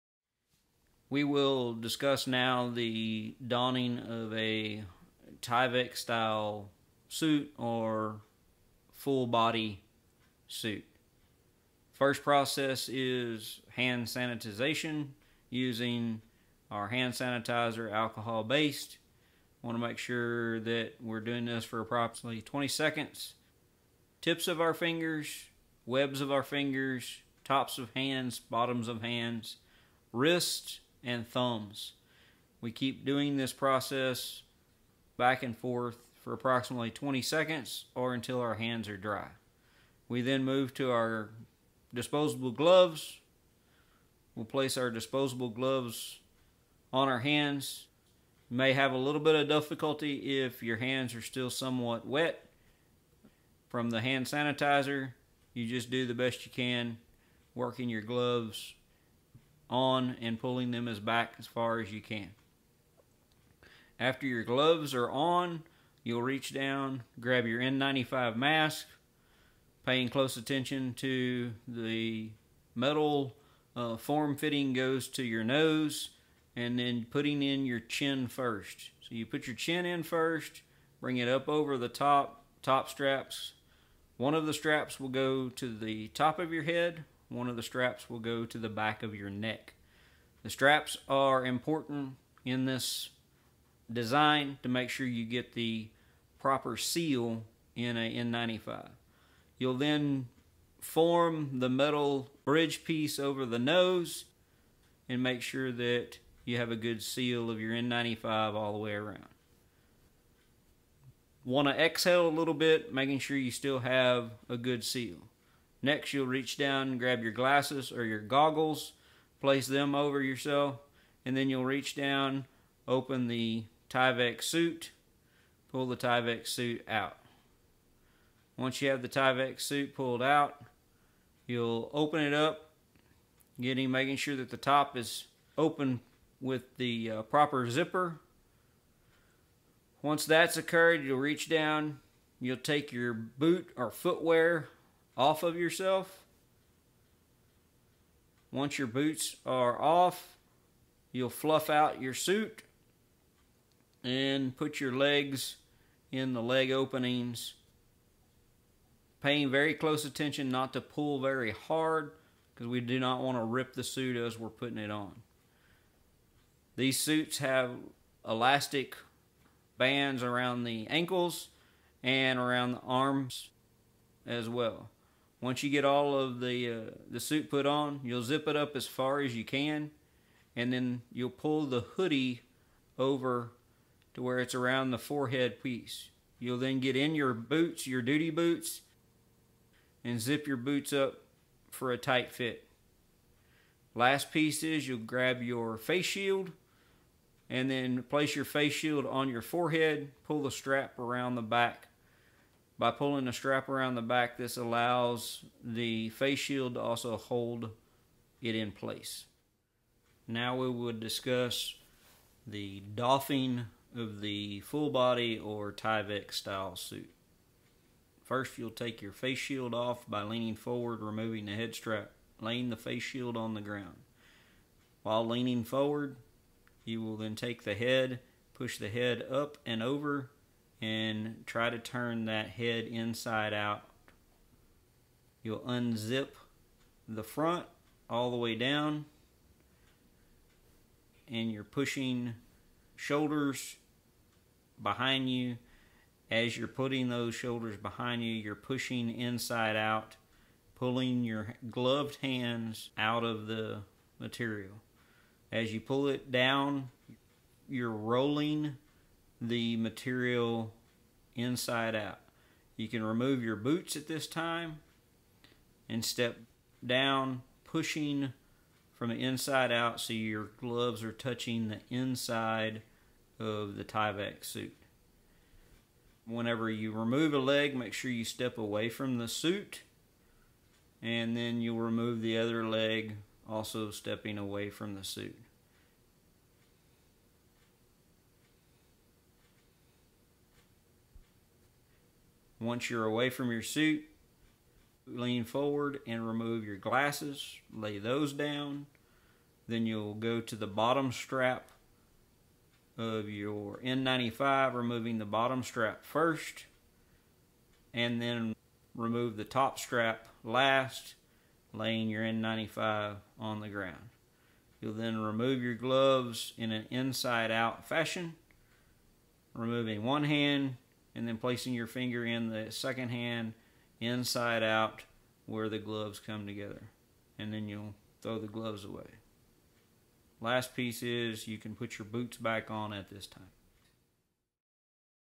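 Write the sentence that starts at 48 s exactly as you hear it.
You may have a little bit of difficulty if your hands are still somewhat wet from the hand sanitizer.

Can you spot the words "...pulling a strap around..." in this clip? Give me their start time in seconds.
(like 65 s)
202 s.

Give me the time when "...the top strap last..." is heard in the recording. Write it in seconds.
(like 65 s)
309 s.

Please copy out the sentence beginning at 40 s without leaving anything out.
We then move to our disposable gloves.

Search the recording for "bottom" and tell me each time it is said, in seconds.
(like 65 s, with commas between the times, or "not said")
28 s, 300 s, 305 s.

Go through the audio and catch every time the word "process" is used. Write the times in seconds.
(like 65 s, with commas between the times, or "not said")
12 s, 33 s.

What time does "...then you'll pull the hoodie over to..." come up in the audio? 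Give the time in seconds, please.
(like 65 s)
180 s.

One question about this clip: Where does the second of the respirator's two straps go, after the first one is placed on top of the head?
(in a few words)
Back of your neck.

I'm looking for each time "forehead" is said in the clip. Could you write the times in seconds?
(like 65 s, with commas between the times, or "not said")
184 s, 199 s.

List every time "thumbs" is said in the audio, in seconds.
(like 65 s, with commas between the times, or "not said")
31 s.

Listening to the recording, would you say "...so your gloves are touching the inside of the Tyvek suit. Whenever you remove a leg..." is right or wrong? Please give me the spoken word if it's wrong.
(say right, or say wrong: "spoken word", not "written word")
right.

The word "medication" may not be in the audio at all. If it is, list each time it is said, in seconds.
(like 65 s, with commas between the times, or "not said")
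not said.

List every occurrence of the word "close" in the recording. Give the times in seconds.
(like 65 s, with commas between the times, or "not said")
70 s, 159 s.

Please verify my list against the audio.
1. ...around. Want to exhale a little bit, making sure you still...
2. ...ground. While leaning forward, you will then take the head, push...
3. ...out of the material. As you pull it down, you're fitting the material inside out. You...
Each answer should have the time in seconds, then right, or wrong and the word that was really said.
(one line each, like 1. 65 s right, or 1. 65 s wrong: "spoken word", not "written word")
1. 108 s right
2. 223 s right
3. 252 s wrong: "rolling", not "fitting".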